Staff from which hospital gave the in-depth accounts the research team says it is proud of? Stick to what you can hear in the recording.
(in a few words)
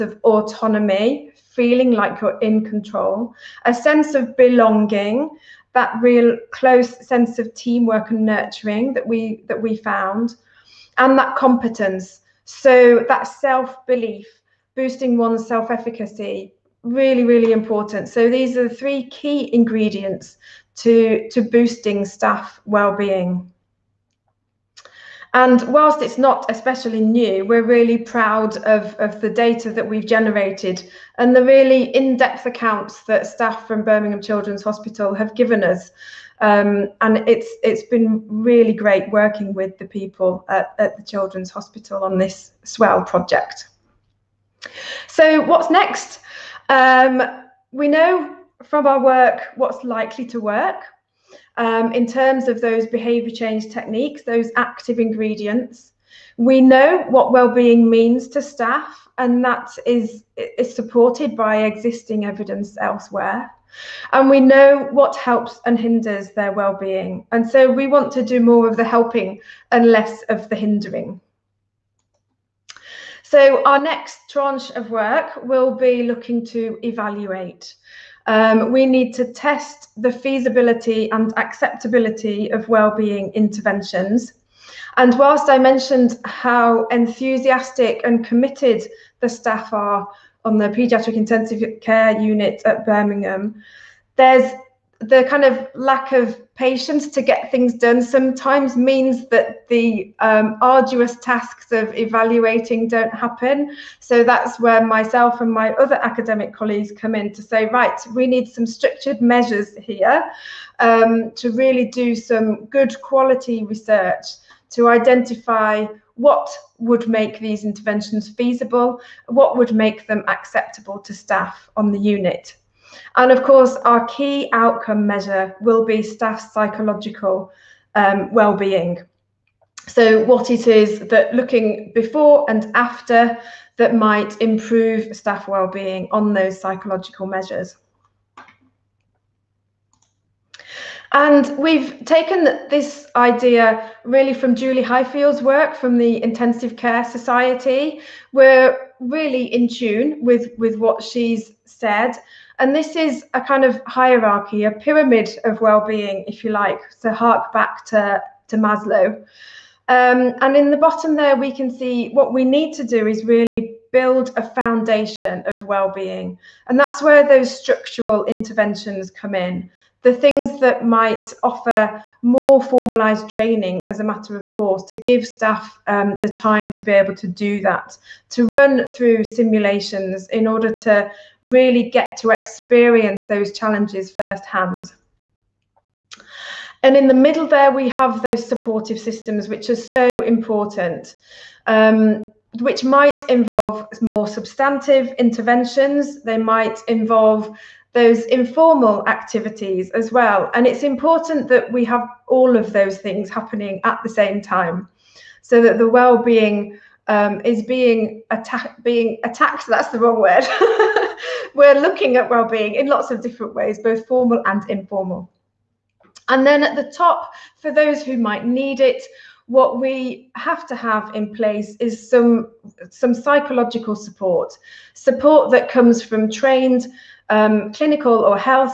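Birmingham Children's Hospital.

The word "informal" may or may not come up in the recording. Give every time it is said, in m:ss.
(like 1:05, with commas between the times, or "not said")
3:18, 3:34.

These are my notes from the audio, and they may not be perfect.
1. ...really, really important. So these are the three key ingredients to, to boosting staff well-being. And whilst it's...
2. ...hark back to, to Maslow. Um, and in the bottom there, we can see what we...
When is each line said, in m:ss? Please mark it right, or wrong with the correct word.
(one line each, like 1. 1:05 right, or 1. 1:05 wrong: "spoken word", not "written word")
1. 0:16 right
2. 2:37 right.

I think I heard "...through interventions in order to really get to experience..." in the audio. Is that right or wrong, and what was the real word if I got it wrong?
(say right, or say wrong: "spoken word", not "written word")
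wrong: "simulations", not "interventions".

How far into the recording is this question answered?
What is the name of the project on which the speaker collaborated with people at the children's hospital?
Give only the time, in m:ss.
0:42.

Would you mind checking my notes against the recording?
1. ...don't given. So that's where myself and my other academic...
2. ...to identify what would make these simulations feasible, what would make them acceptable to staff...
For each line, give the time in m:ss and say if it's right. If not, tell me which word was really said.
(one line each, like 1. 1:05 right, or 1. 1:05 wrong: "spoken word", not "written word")
1. 1:42 wrong: "happen", not "given"
2. 1:54 wrong: "interventions", not "simulations".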